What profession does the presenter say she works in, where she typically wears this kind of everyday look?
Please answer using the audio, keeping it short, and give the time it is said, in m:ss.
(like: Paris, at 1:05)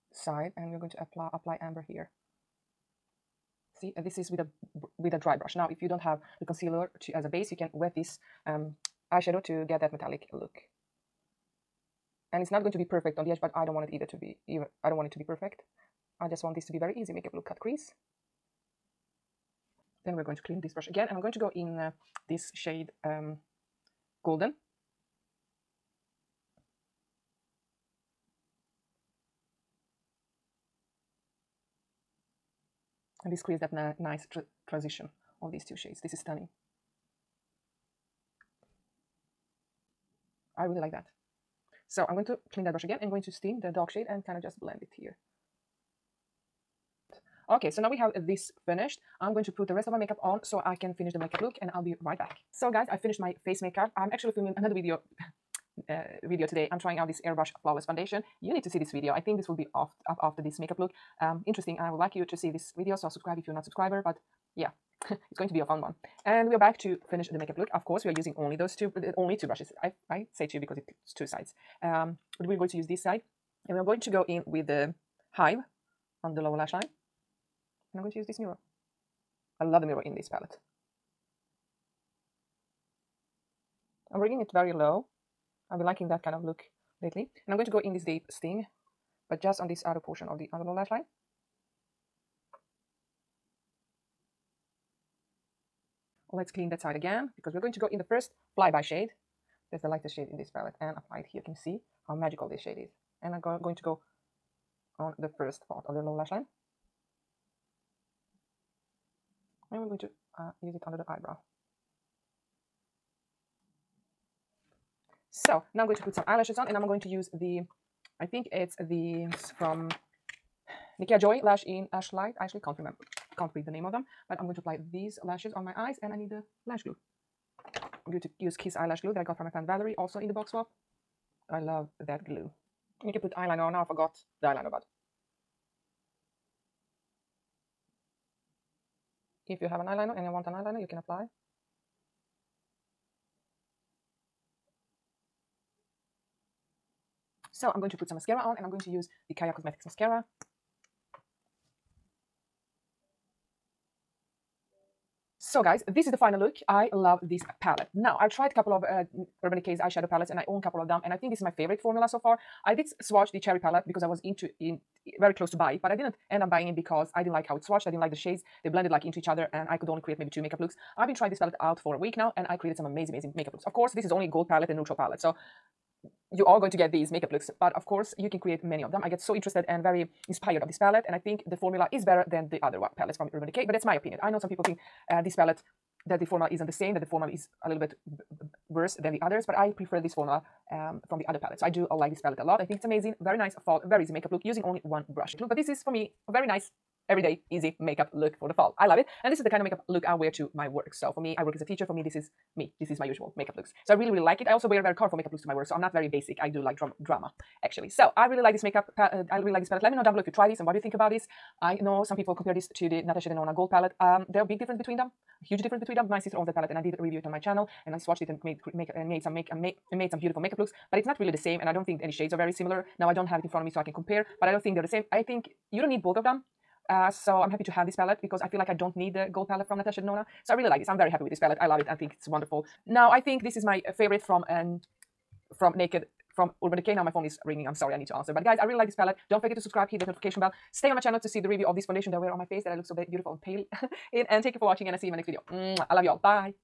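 Teacher, at 3:21.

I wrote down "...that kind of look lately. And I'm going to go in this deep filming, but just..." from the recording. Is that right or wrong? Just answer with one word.
wrong.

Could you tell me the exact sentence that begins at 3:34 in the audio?
Um, there are big difference between them huge difference between them.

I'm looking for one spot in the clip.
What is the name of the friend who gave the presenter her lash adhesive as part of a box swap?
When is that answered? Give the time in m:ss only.
2:09.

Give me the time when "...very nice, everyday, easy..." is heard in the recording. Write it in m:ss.
3:16.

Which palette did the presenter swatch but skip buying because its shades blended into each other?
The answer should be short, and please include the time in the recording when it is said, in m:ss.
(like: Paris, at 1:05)
The cherry palette, at 2:43.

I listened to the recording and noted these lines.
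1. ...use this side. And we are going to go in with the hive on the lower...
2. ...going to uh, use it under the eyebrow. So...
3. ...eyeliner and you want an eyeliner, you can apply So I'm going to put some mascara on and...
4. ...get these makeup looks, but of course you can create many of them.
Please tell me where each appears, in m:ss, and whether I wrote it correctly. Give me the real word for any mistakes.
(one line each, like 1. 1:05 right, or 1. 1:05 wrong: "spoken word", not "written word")
1. 1:12 right
2. 1:49 right
3. 2:19 right
4. 2:56 right.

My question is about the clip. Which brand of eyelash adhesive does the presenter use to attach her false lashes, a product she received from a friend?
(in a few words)
Kiss Eyelash Glue.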